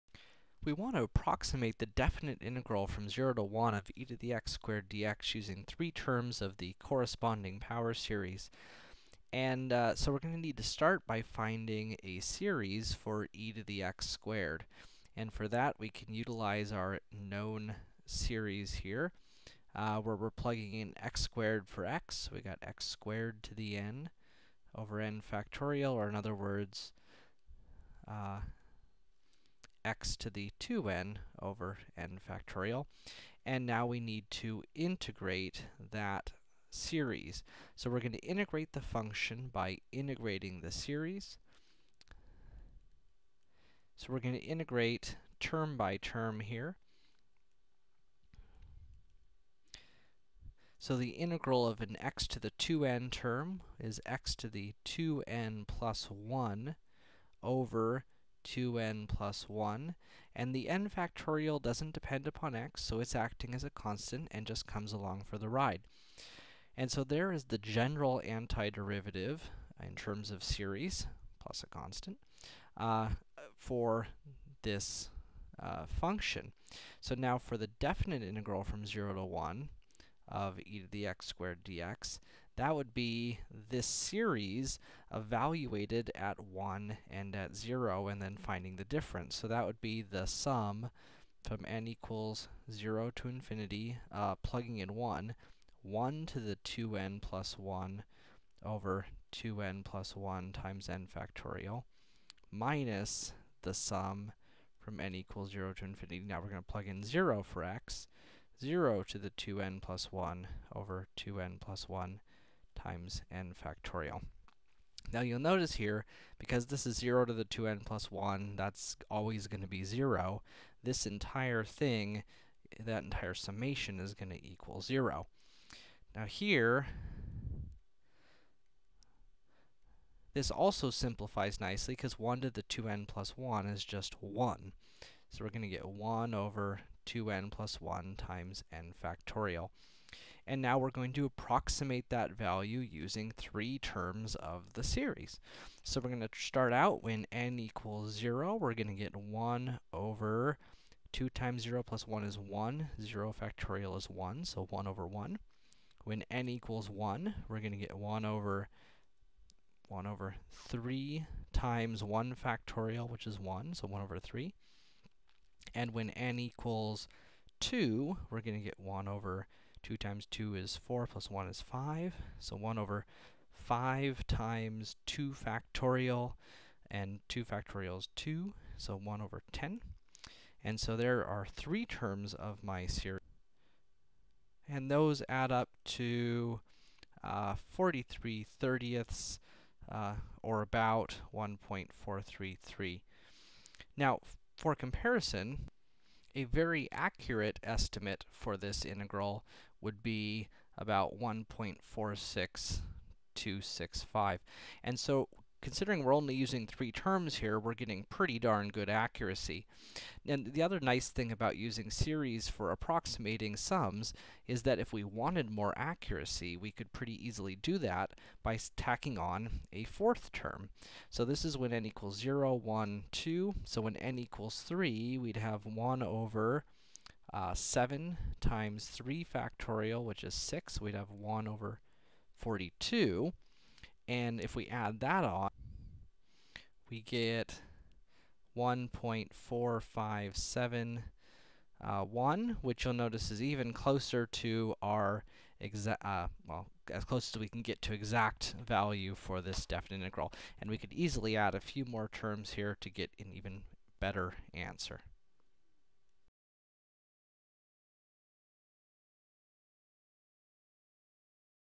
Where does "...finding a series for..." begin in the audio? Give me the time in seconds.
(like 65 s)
11 s.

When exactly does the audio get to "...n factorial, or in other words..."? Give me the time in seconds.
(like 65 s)
25 s.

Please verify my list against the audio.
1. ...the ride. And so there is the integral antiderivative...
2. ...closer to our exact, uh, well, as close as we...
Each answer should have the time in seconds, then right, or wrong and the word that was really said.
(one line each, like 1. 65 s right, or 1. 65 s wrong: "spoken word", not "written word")
1. 65 s wrong: "general", not "integral"
2. 243 s right.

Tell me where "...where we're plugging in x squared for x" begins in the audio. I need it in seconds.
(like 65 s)
19 s.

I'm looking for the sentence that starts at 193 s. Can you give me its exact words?
Now, for comparison, a very accurate estimate for this integral would be about 1.46265.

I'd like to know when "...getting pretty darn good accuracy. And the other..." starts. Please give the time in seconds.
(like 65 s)
207 s.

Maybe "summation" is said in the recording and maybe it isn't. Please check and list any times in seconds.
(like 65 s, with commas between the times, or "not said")
123 s.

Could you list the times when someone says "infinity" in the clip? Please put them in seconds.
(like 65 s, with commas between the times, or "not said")
93 s, 105 s.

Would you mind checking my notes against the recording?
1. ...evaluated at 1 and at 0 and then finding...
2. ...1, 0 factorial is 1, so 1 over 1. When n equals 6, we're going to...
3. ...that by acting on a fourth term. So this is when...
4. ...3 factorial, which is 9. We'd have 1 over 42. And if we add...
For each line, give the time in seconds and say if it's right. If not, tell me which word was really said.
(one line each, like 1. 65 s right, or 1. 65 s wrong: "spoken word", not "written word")
1. 85 s right
2. 152 s wrong: "1", not "6"
3. 217 s wrong: "tacking", not "acting"
4. 228 s wrong: "6", not "9".